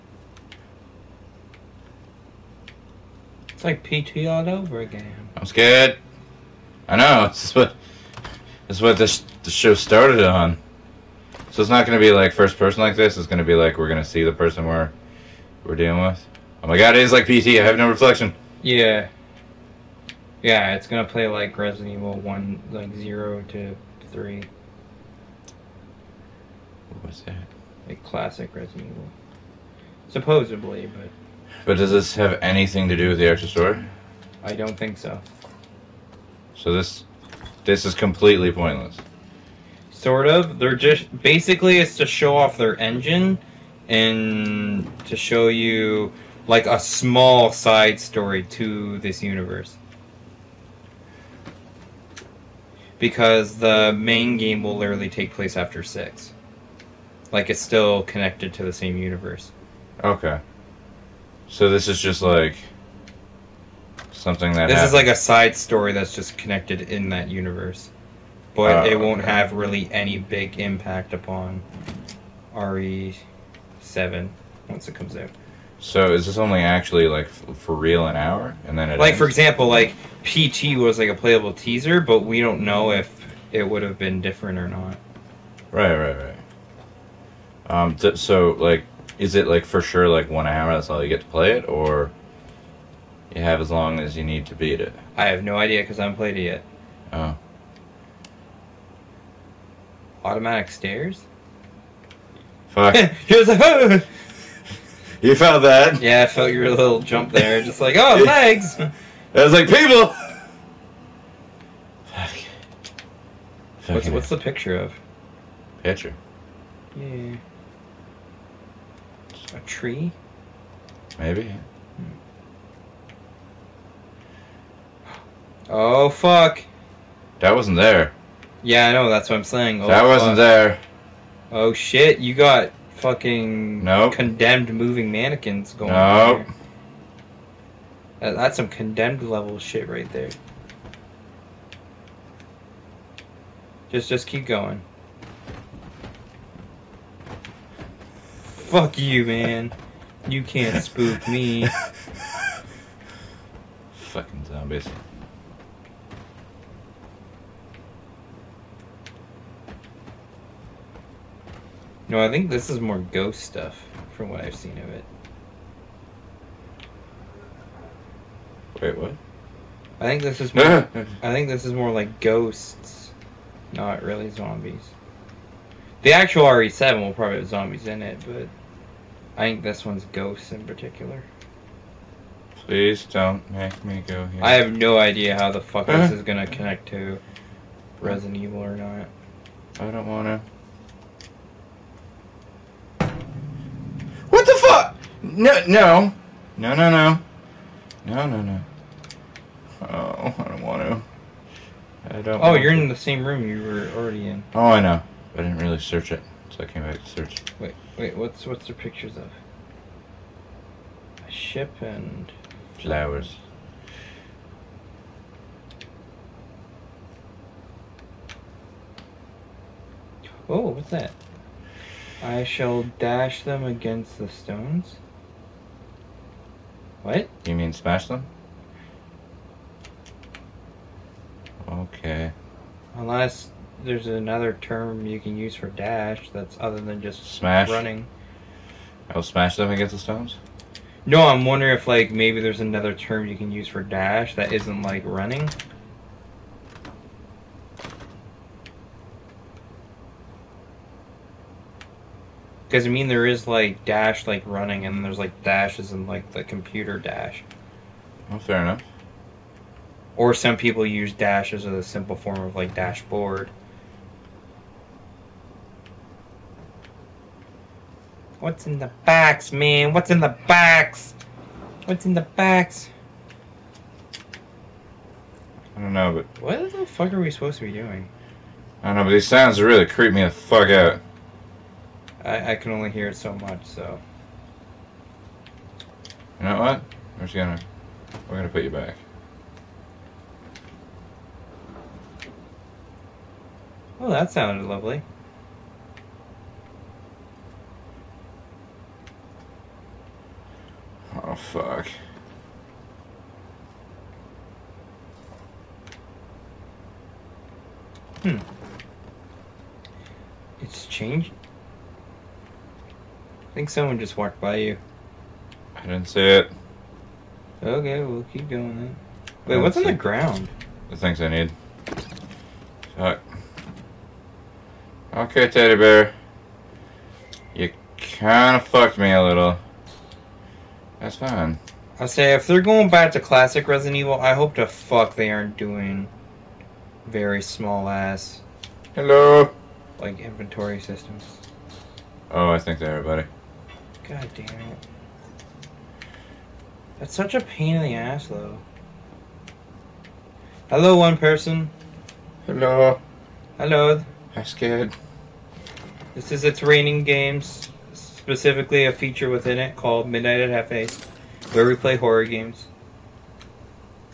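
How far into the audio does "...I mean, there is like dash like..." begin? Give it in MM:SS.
04:12.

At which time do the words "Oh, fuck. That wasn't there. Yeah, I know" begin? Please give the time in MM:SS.
02:05.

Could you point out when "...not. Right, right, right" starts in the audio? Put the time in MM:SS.
01:24.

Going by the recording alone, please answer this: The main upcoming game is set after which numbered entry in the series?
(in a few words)
6.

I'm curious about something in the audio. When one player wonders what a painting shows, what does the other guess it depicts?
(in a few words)
A tree.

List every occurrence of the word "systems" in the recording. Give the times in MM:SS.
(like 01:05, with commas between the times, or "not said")
05:40.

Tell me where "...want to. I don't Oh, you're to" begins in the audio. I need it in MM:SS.
03:20.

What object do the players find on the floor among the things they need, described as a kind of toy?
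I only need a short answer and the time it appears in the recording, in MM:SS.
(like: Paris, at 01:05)
teddy bear, at 05:25.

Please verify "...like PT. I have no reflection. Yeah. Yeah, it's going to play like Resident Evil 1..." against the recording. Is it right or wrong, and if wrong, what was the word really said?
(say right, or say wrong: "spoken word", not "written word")
right.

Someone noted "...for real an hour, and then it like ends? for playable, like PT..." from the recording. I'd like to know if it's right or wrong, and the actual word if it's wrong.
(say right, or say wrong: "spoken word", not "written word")
wrong: "example", not "playable".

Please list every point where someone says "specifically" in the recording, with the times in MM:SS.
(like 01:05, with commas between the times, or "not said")
05:57.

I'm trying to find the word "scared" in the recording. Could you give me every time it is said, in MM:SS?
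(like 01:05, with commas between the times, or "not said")
00:05, 05:54.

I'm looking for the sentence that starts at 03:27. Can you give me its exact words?
Wait, wait, what's what's the pictures of?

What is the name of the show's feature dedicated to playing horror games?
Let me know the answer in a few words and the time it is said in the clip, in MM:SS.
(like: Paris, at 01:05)
Midnight at Hef-A, at 06:00.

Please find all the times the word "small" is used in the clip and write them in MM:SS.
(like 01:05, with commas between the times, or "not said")
00:46, 05:37.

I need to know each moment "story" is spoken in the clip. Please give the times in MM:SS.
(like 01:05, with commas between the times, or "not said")
00:33, 00:47, 01:05.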